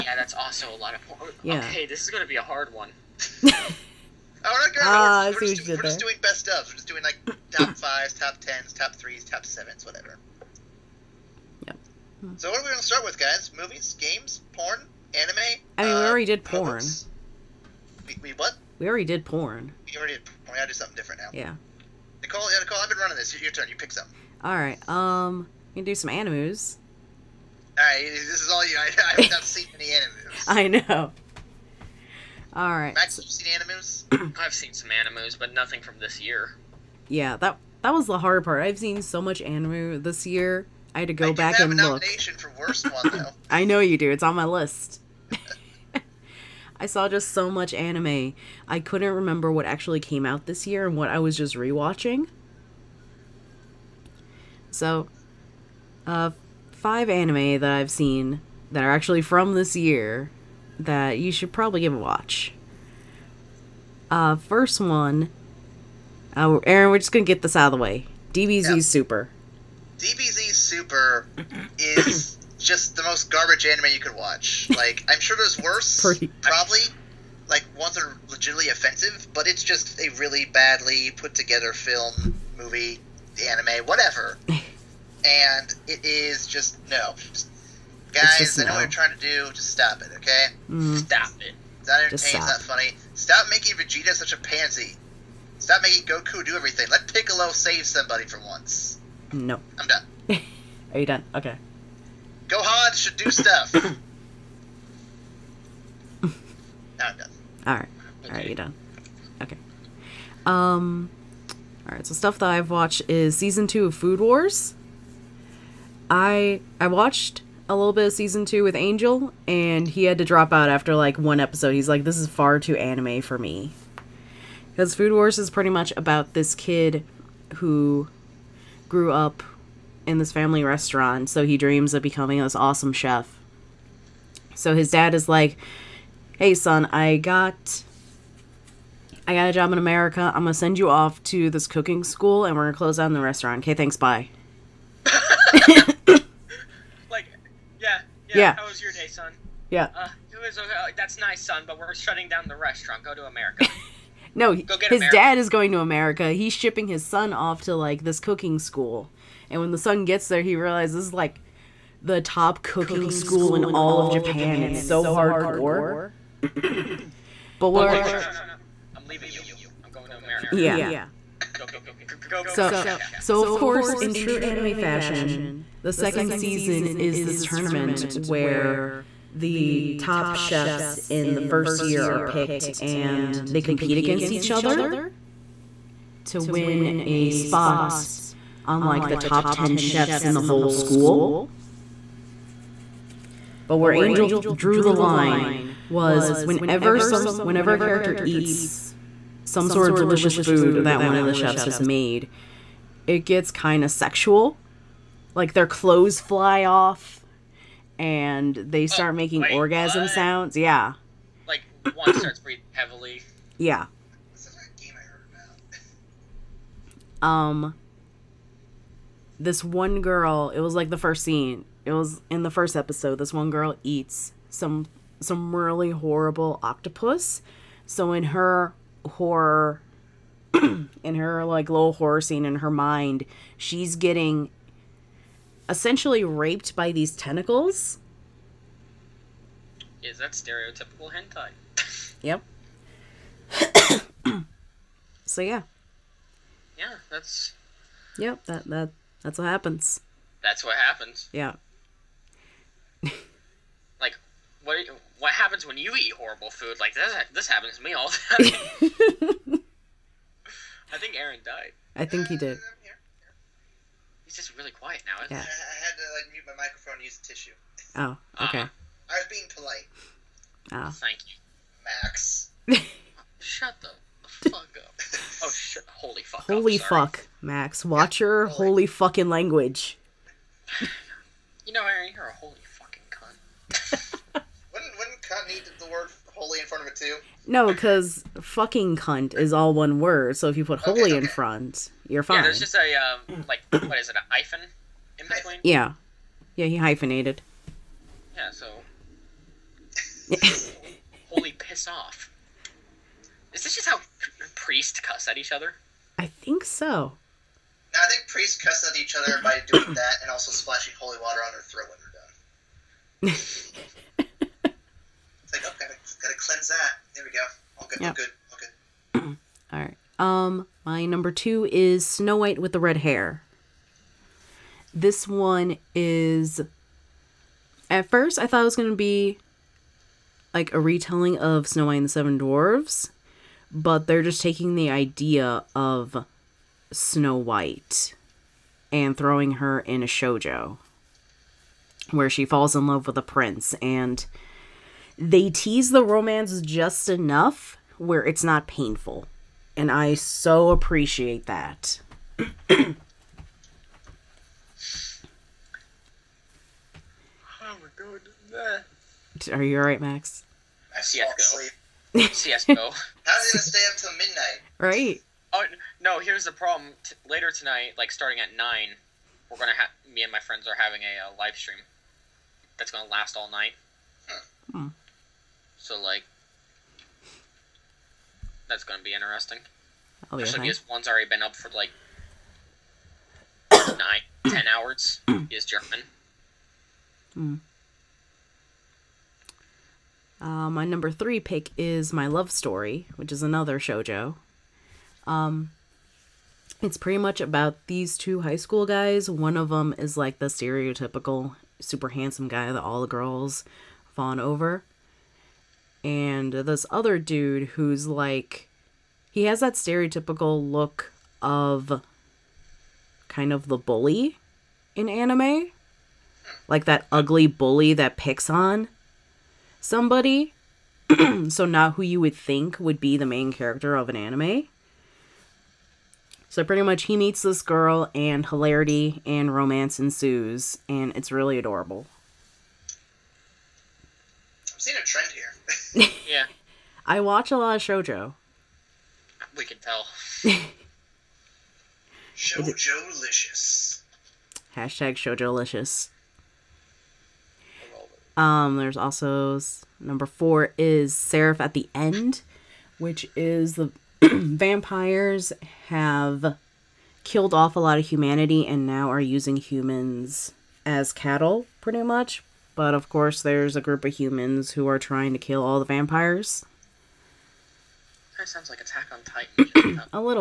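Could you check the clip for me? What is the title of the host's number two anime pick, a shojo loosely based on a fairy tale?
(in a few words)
Snow White with the Red Hair.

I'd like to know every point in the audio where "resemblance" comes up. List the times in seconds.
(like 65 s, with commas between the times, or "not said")
not said.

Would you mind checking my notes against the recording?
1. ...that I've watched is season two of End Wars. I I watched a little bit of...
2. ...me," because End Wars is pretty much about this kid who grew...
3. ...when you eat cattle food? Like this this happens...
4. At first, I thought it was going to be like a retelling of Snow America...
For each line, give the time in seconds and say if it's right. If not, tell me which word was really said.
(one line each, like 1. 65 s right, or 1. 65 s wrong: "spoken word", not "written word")
1. 112 s wrong: "Food", not "End"
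2. 123 s wrong: "Food", not "End"
3. 255 s wrong: "horrible", not "cattle"
4. 327 s wrong: "White", not "America".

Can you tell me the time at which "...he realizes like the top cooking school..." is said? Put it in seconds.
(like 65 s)
160 s.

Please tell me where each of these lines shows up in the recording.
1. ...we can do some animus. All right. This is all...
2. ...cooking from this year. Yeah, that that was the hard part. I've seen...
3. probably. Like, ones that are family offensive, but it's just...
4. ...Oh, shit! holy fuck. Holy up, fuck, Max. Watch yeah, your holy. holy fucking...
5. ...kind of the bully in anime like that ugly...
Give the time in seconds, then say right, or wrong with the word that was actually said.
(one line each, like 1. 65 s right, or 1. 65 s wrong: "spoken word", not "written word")
1. 25 s right
2. 35 s wrong: "nothing", not "cooking"
3. 76 s wrong: "legitimately", not "family"
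4. 275 s right
5. 413 s right.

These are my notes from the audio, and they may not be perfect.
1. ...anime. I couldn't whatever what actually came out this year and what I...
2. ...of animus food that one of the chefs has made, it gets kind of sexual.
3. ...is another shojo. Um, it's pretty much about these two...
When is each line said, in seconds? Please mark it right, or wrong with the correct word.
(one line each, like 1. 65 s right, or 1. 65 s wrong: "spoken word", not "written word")
1. 47 s wrong: "remember", not "whatever"
2. 199 s wrong: "delicious", not "animus"
3. 393 s right.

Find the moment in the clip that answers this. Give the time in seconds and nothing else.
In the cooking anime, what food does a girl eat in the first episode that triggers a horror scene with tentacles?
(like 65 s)
226 s.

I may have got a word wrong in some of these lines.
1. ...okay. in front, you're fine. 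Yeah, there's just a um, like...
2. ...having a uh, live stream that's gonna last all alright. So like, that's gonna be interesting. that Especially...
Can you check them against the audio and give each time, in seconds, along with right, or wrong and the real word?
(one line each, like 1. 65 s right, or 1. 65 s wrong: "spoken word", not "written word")
1. 291 s right
2. 370 s wrong: "night", not "alright".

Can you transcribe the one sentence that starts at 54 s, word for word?
So, uh, five anime that I've seen that are actually from this year that you should probably give a watch.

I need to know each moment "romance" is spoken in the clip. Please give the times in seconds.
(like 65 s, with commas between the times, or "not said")
346 s, 429 s.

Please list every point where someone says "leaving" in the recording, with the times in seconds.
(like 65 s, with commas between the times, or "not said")
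169 s.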